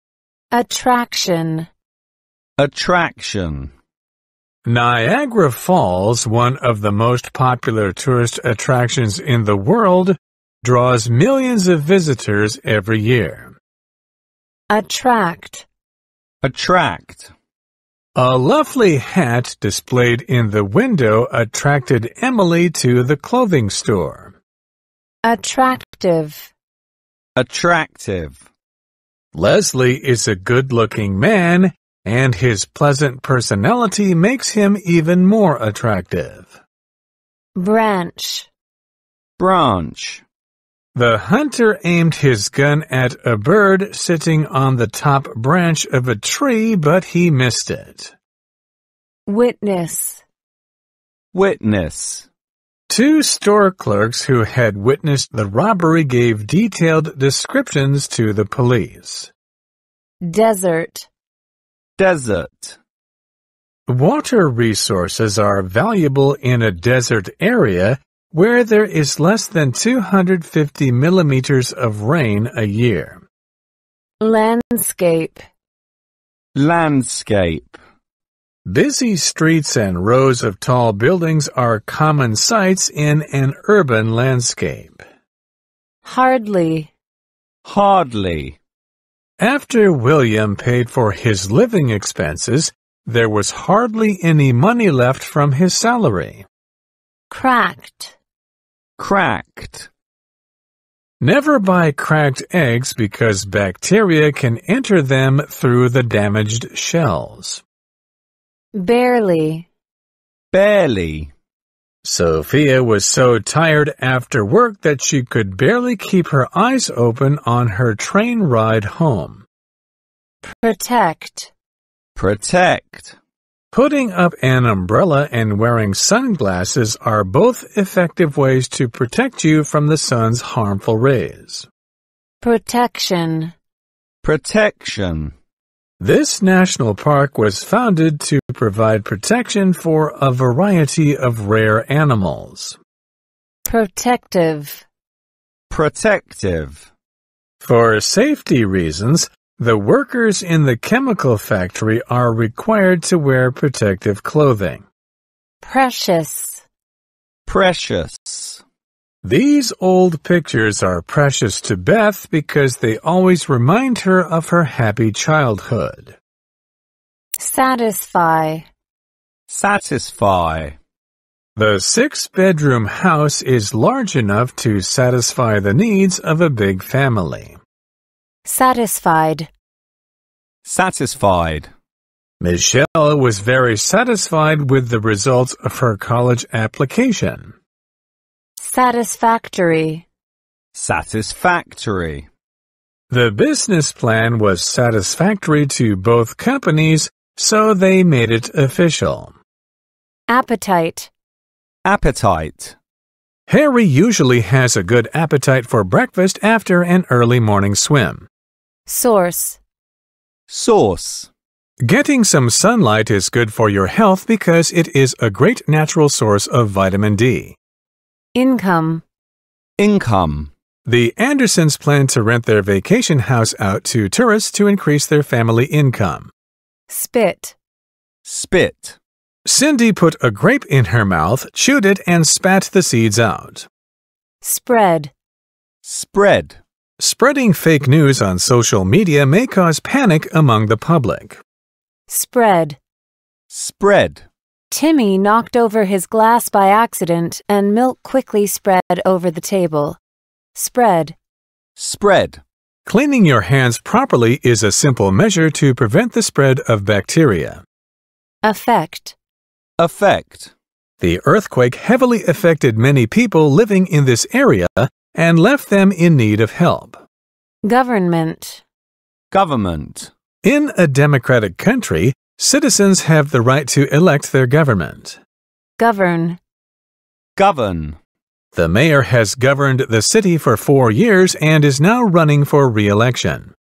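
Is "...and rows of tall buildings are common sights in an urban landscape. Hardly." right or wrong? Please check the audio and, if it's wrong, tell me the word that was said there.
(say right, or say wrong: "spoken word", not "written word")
right.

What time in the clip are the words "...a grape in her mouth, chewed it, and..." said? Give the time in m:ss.
3:50.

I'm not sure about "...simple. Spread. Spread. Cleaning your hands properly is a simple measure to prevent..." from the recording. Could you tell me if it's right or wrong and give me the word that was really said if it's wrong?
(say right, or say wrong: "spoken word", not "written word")
wrong: "table", not "simple".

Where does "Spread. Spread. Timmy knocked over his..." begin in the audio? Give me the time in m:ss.
4:02.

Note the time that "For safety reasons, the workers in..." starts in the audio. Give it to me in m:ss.
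2:27.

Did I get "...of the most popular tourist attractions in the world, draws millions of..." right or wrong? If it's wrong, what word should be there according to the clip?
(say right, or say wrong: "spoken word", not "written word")
right.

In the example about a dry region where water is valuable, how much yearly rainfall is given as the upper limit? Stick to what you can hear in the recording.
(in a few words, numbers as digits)
250 millimeters.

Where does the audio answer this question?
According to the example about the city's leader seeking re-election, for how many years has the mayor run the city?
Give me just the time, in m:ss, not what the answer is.
4:40.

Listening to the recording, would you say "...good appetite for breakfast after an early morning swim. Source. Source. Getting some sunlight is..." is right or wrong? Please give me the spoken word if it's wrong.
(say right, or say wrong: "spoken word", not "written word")
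right.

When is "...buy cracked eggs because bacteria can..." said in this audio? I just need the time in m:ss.
1:41.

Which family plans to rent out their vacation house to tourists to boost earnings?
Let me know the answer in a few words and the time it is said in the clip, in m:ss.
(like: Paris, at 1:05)
The Andersons, at 3:40.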